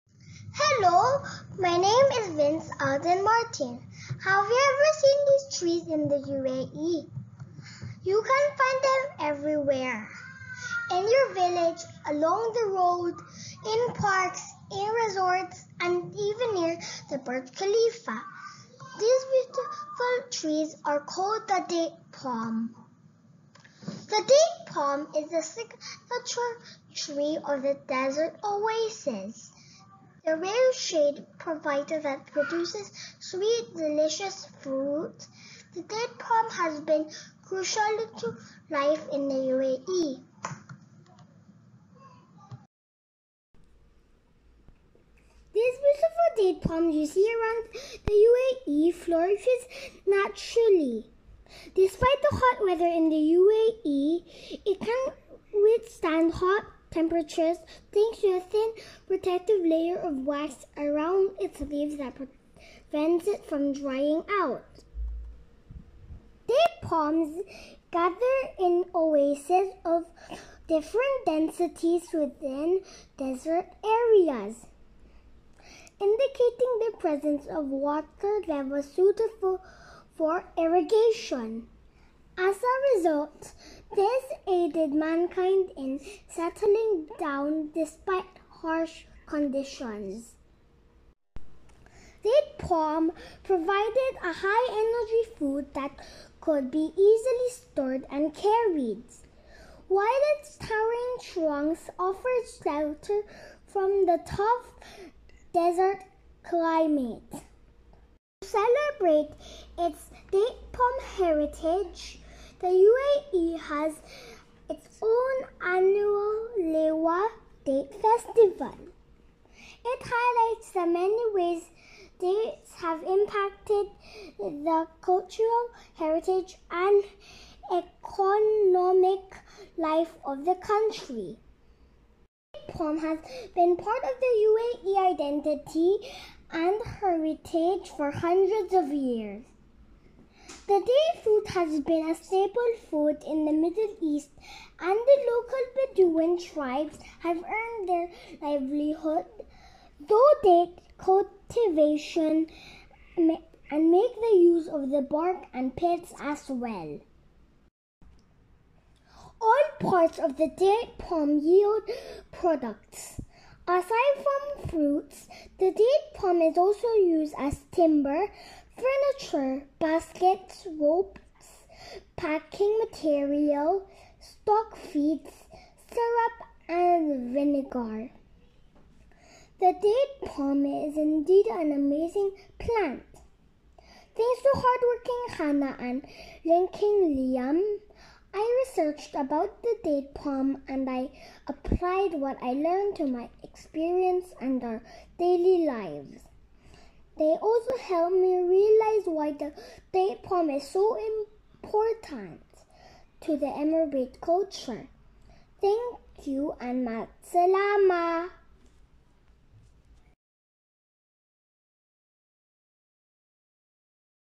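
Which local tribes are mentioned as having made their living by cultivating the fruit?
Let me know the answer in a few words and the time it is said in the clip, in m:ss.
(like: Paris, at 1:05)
Bedouin, at 2:25.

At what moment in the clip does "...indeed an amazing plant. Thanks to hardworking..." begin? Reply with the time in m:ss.
3:00.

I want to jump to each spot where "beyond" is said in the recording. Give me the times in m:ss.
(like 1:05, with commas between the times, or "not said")
not said.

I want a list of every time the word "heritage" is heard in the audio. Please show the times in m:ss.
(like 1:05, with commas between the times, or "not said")
1:51, 2:05, 2:16.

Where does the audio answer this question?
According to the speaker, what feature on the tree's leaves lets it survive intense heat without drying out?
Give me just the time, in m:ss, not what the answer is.
0:58.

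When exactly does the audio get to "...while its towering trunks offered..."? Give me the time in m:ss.
1:39.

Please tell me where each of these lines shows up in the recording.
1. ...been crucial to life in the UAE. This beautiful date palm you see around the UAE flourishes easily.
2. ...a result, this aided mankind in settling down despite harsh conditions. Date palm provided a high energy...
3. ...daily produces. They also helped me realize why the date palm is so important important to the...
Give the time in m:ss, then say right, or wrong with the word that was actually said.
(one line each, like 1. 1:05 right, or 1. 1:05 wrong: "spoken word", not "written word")
1. 0:36 wrong: "naturally", not "easily"
2. 1:22 right
3. 3:15 wrong: "lives", not "produces".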